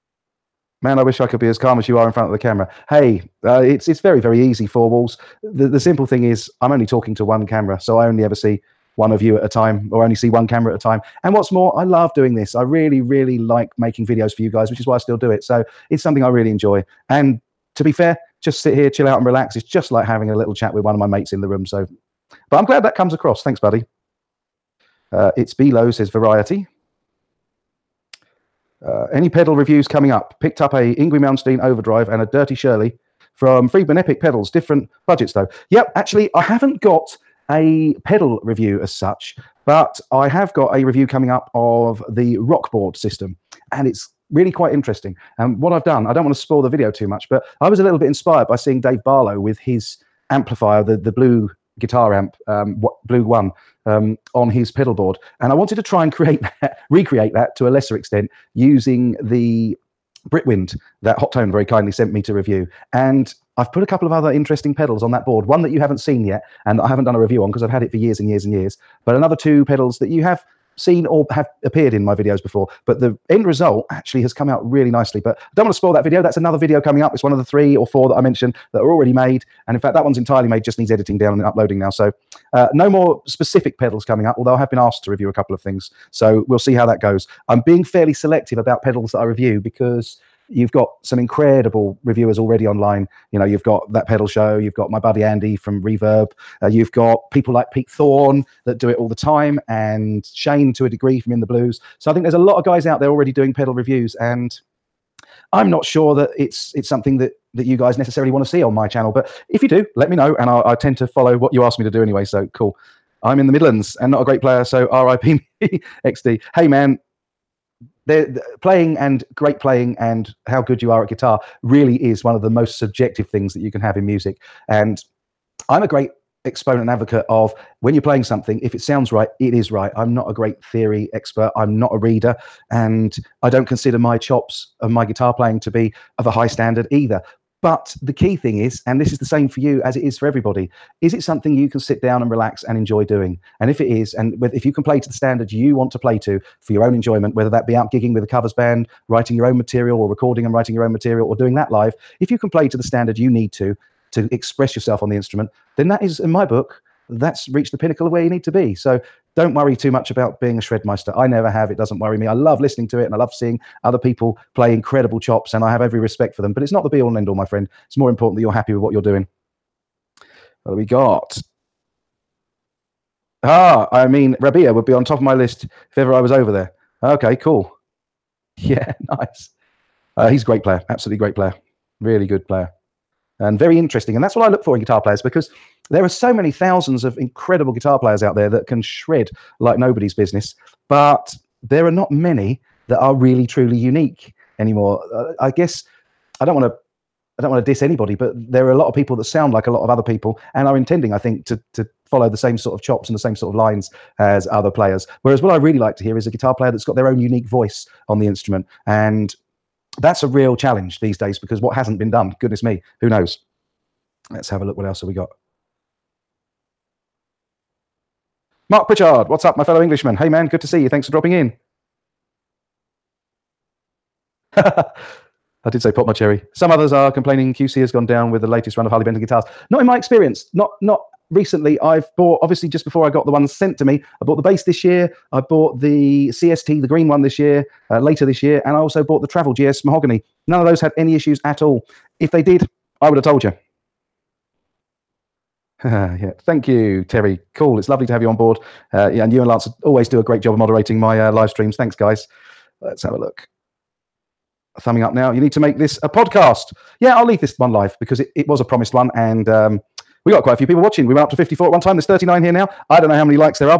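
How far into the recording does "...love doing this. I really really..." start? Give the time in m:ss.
0:11.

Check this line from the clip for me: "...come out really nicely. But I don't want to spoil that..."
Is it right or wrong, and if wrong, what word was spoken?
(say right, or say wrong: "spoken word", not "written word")
right.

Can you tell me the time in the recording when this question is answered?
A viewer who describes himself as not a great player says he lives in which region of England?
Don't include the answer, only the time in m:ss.
1:53.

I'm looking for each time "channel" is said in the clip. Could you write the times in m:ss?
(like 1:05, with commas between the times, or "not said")
1:48.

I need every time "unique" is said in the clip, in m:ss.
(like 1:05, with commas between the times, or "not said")
3:13, 3:27.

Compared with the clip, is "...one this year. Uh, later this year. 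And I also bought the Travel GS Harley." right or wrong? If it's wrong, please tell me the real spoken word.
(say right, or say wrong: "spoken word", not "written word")
wrong: "Mahogany", not "Harley".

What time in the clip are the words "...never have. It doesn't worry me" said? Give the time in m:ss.
2:41.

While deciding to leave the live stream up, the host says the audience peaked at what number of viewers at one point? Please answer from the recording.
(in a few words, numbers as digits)
54.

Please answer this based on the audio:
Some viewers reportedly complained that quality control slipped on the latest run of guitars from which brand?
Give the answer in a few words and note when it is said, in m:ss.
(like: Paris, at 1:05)
Harley Benton, at 3:48.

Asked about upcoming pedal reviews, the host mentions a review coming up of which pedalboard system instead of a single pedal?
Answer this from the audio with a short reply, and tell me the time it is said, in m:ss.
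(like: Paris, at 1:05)
Rockboard, at 0:42.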